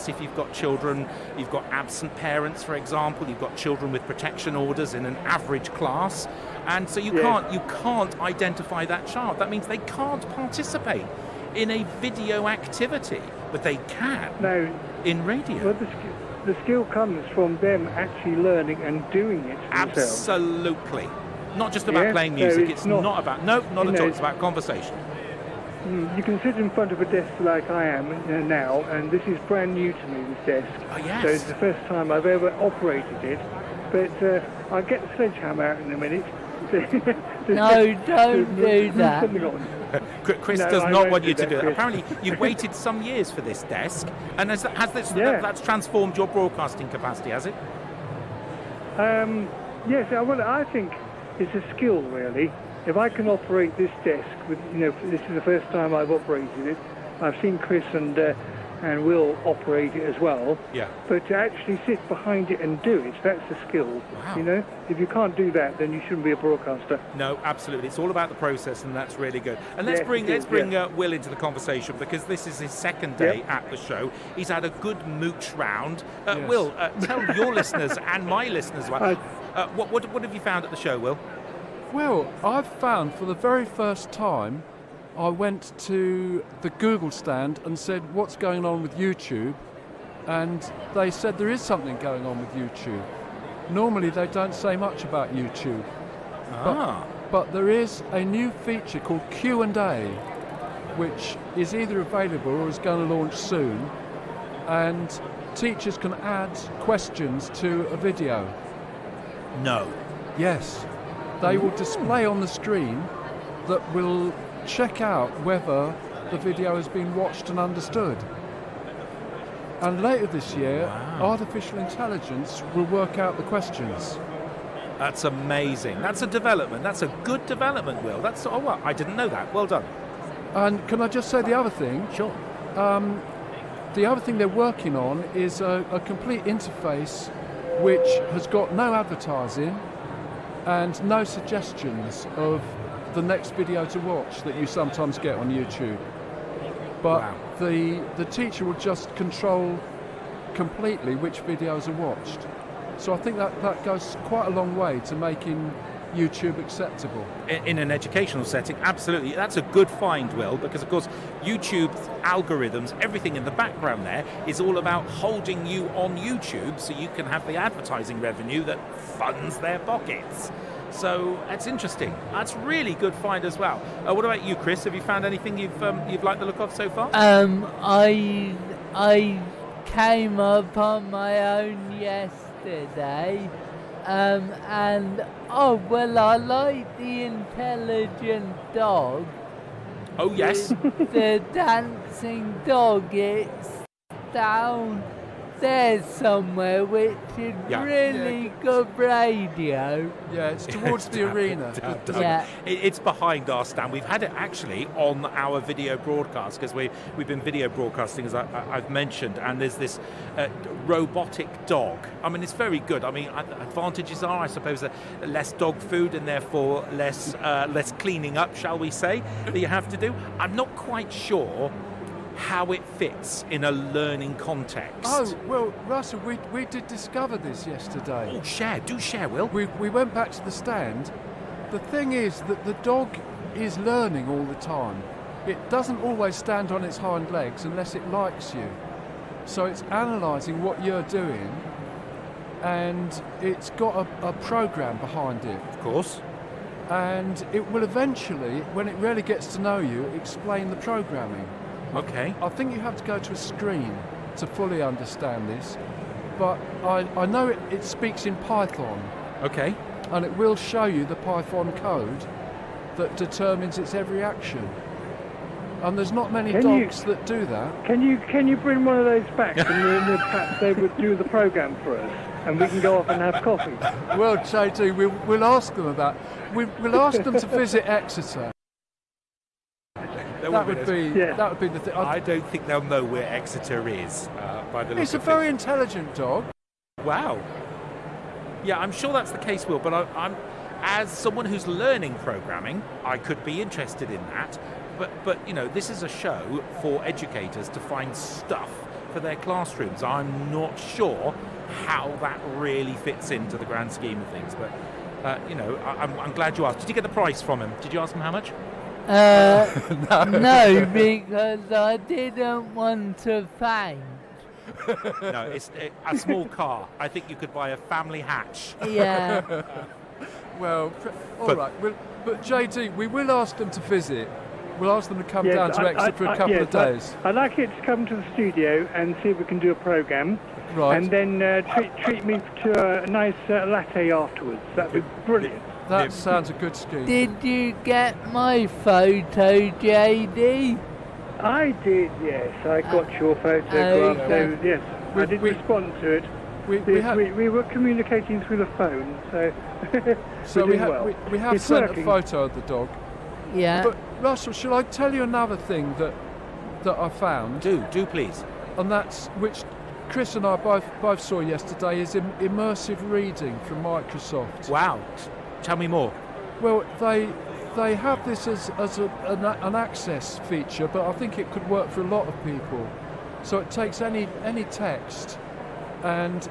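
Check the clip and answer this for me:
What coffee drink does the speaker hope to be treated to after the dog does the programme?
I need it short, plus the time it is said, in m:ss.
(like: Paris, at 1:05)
latte, at 5:33.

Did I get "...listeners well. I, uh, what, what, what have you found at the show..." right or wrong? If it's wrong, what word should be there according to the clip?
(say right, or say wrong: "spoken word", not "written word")
right.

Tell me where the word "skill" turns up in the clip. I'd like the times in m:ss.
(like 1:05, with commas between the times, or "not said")
0:16, 0:51, 1:03.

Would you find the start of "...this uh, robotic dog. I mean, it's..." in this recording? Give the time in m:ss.
3:29.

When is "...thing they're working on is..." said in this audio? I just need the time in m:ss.
2:14.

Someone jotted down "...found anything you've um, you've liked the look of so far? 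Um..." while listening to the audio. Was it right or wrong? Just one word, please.
right.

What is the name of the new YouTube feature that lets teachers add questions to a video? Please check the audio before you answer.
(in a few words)
Q&A.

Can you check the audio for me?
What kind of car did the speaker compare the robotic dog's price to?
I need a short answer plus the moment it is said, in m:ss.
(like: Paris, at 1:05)
a family hatch, at 5:17.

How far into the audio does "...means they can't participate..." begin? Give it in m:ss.
0:09.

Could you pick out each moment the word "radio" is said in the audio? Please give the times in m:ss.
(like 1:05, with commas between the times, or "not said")
0:15, 3:18.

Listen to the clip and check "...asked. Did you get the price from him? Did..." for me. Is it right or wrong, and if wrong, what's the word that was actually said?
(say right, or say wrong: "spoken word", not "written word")
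right.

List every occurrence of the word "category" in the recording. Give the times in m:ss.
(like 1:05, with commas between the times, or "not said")
not said.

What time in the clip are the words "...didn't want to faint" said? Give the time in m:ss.
5:11.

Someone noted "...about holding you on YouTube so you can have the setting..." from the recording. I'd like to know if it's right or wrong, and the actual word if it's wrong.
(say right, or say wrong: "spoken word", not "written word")
wrong: "advertising", not "setting".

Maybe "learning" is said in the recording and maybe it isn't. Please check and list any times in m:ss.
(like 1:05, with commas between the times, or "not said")
0:18, 3:43, 3:53, 4:51.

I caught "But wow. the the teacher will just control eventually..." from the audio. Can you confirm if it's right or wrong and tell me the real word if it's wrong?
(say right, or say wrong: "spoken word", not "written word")
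wrong: "completely", not "eventually".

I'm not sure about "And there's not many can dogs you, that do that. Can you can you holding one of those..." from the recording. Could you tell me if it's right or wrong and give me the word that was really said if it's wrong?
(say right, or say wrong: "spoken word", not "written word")
wrong: "bring", not "holding".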